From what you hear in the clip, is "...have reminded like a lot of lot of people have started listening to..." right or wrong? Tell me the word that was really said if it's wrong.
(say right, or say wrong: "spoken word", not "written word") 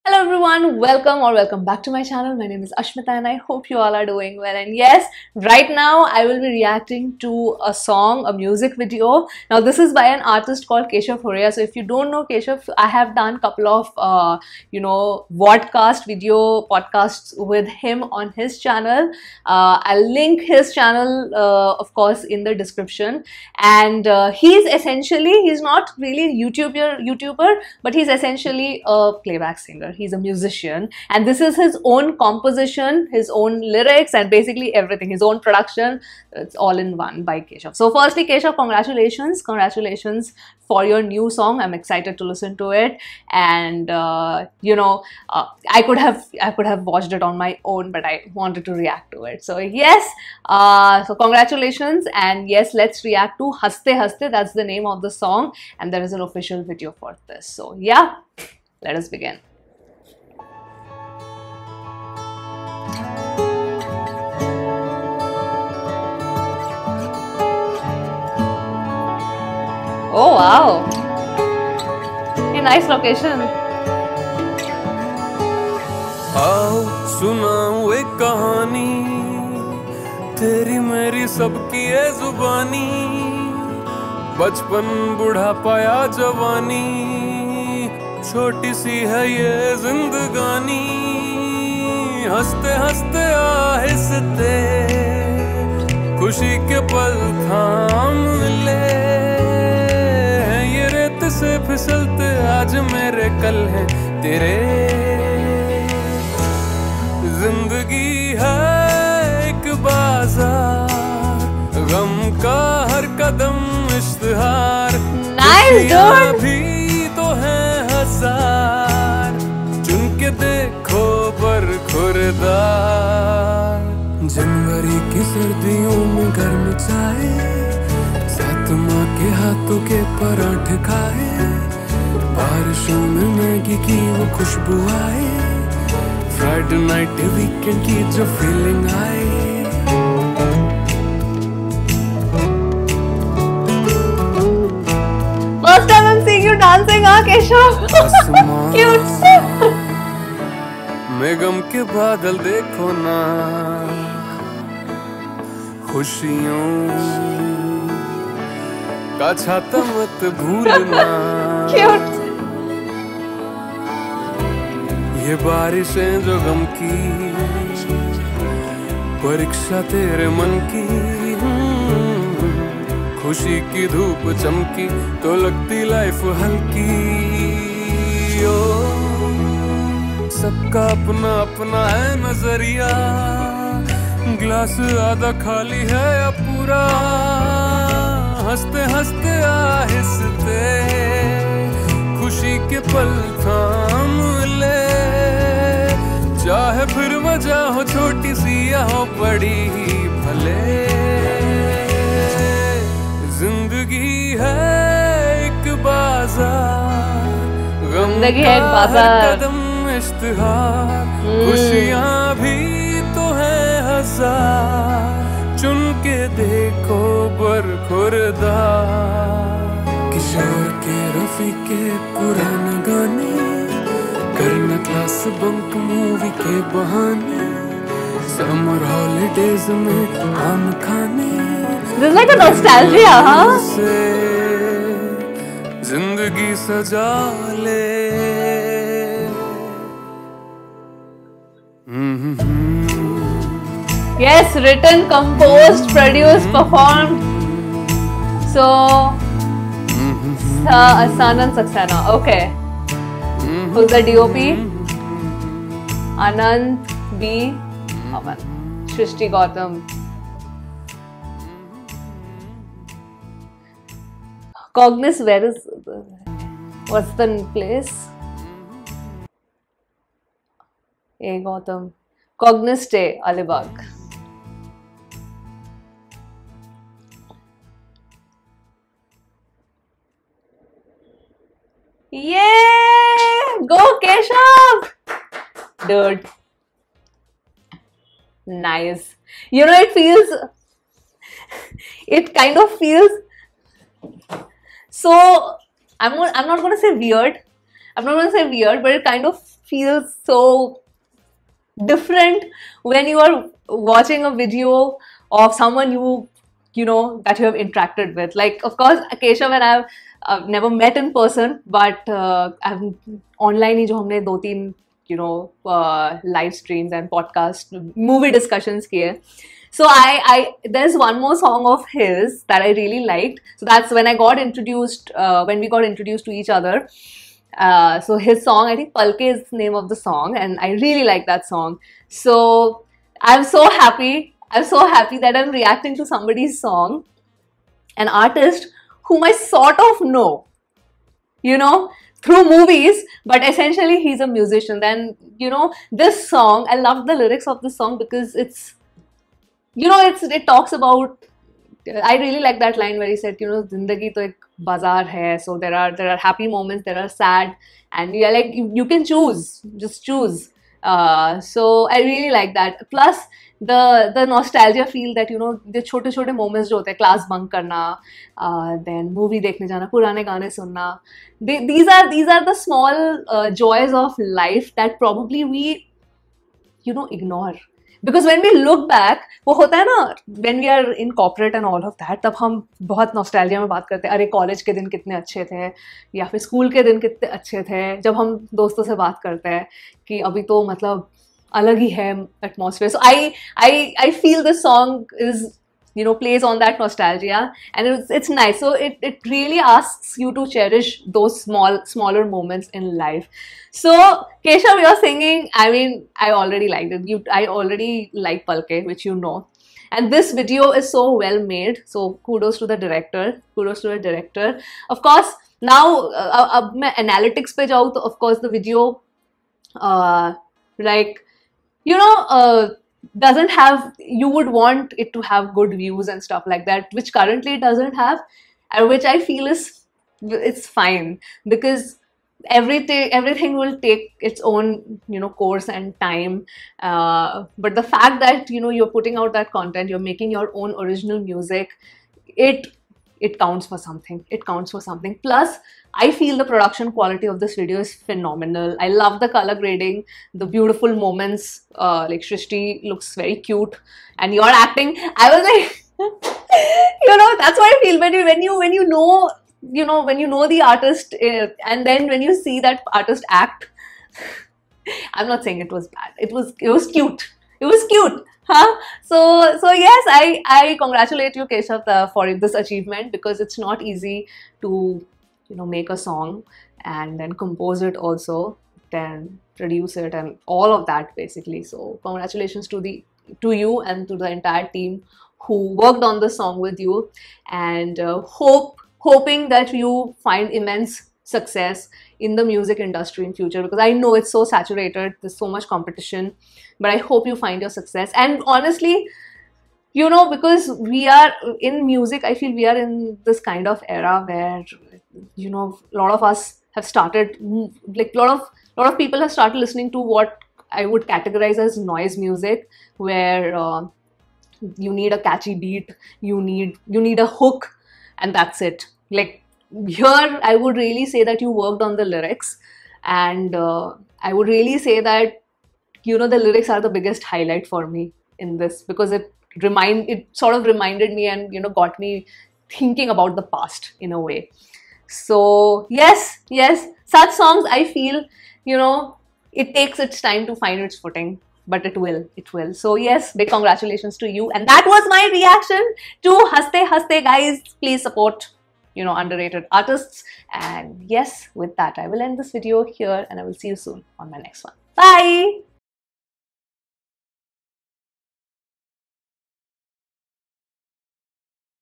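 wrong: "started", not "reminded".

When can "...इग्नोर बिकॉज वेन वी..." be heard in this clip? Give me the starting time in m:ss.
6:17.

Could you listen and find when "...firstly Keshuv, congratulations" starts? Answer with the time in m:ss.
0:37.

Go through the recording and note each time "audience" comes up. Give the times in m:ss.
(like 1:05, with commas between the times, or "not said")
not said.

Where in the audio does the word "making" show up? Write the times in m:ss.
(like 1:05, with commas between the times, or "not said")
7:20.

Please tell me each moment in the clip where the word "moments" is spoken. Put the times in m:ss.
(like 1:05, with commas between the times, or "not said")
5:56, 7:30.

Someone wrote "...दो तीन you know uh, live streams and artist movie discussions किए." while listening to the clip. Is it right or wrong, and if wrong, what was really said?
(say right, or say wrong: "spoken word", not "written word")
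wrong: "podcast", not "artist".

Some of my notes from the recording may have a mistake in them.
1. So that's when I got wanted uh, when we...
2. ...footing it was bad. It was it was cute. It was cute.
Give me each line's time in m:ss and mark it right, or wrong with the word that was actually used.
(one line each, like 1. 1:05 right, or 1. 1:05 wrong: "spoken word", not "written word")
1. 5:23 wrong: "introduced", not "wanted"
2. 7:45 wrong: "saying", not "footing".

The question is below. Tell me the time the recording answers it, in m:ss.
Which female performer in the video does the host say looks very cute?
7:32.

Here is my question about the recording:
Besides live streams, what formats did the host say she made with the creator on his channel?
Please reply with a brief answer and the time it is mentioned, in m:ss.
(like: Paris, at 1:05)
Vodcast video podcasts, at 0:15.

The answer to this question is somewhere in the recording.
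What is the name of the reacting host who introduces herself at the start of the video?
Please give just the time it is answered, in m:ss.
0:02.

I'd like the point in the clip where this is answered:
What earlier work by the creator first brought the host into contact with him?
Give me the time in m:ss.
5:28.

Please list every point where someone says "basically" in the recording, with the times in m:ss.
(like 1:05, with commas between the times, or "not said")
0:34, 8:01.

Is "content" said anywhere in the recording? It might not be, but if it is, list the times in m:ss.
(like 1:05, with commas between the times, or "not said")
7:19.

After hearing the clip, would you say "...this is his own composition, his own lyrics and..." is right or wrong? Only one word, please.
right.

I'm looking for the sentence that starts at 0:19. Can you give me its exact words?
Uh, I'll link his channel, uh, of course, in the description.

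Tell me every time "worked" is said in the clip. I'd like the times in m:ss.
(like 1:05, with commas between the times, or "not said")
8:05, 8:41.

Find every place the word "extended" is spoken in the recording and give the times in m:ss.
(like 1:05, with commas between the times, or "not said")
not said.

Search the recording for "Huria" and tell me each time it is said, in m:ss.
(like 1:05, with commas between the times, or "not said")
0:11.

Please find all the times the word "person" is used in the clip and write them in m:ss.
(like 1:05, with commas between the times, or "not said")
5:11.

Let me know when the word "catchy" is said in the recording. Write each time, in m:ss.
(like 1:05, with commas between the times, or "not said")
8:35.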